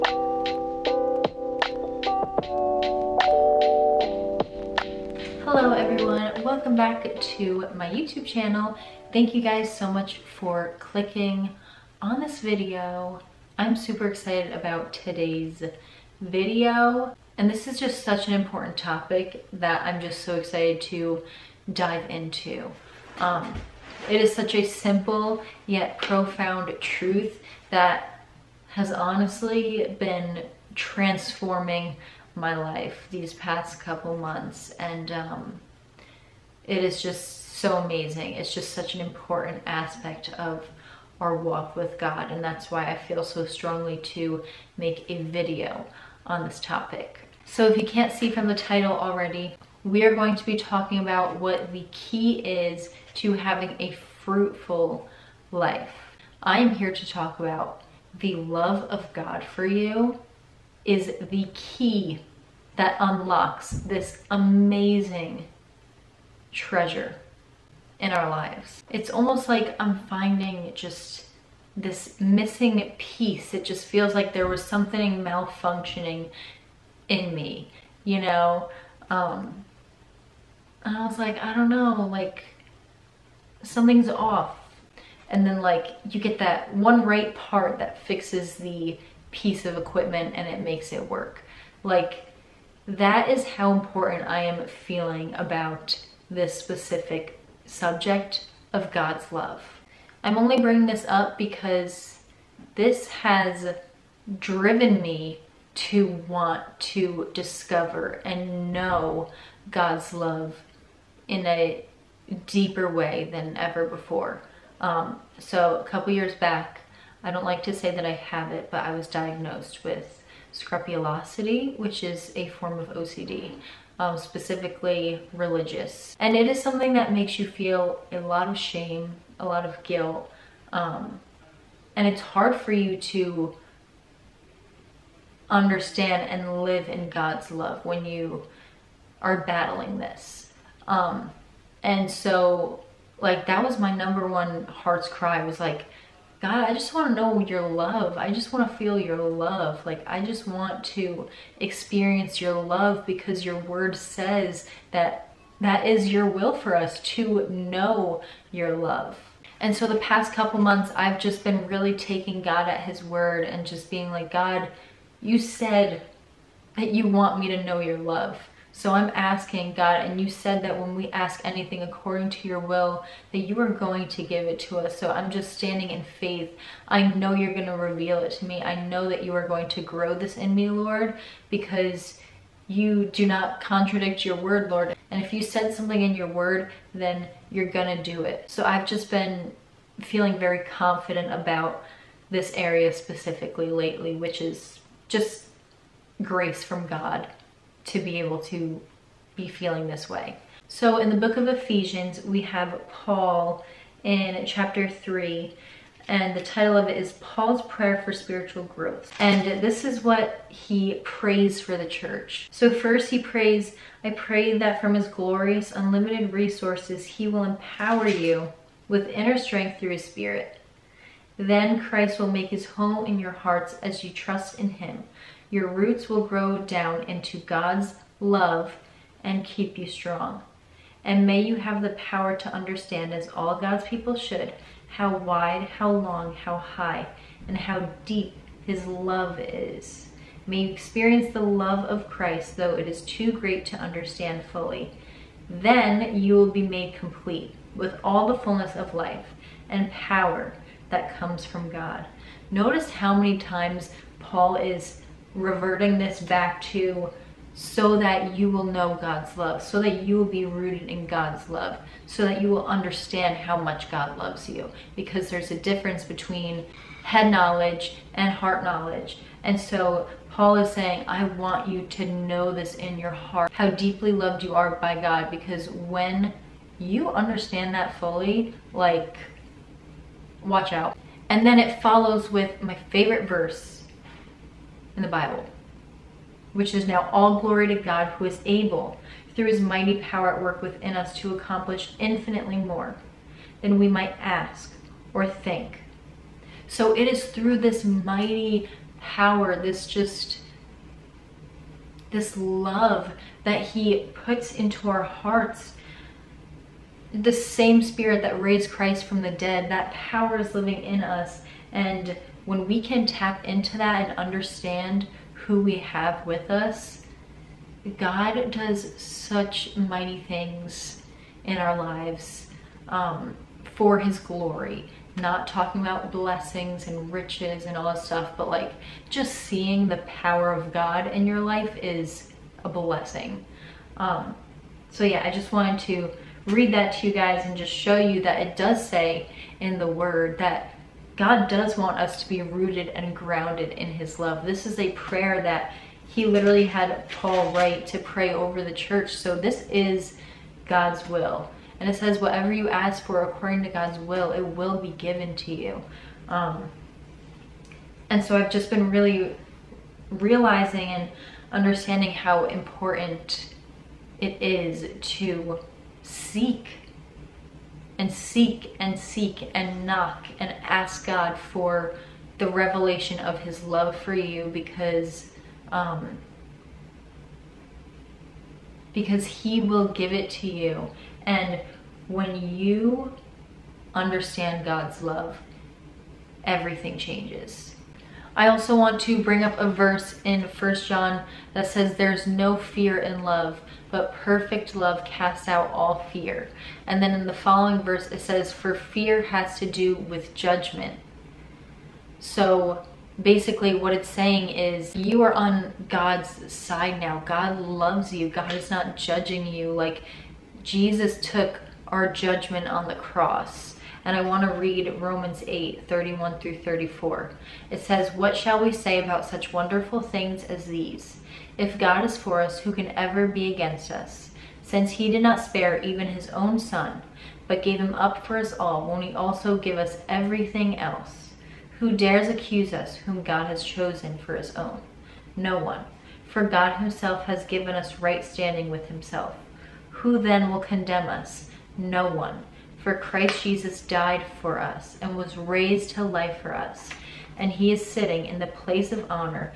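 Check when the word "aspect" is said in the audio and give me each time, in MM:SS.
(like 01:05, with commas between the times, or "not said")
00:39.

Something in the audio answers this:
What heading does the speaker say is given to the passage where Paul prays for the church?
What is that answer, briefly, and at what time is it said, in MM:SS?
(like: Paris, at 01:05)
Paul's Prayer for Spiritual Growth, at 03:27.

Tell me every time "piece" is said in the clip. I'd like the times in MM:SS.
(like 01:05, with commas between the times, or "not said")
01:12, 01:29.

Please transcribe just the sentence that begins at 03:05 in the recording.
And if you said something in your word, then you're going to do it.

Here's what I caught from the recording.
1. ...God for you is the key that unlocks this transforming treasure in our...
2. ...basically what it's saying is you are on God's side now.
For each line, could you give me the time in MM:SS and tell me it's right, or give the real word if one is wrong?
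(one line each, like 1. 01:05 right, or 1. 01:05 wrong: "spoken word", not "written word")
1. 00:59 wrong: "amazing", not "transforming"
2. 06:43 right.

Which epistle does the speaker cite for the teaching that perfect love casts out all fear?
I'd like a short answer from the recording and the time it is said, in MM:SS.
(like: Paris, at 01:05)
First John, at 06:30.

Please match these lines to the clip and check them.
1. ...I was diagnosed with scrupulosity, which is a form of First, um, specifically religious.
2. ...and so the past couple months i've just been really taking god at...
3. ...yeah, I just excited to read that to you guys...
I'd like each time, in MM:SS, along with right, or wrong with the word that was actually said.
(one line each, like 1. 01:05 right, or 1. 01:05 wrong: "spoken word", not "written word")
1. 01:58 wrong: "OCD", not "First"
2. 02:39 right
3. 05:35 wrong: "wanted", not "excited".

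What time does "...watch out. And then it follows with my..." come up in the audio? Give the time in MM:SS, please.
04:40.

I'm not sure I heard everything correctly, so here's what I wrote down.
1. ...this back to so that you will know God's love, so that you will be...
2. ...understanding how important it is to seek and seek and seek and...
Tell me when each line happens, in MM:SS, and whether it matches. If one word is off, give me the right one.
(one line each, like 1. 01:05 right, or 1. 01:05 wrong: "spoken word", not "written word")
1. 04:15 right
2. 06:01 right.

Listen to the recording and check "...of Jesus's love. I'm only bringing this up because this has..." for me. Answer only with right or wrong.
wrong.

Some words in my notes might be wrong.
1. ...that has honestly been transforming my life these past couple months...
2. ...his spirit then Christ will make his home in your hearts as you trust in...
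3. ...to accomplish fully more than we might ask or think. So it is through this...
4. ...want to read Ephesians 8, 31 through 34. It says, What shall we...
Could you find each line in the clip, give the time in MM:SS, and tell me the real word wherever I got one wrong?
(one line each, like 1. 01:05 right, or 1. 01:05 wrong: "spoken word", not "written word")
1. 00:27 right
2. 03:39 right
3. 04:51 wrong: "infinitely", not "fully"
4. 06:54 wrong: "Romans", not "Ephesians".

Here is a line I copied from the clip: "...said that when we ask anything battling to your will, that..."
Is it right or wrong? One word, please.
wrong.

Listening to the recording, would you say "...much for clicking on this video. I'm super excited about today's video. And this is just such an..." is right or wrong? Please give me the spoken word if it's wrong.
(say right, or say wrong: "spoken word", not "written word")
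right.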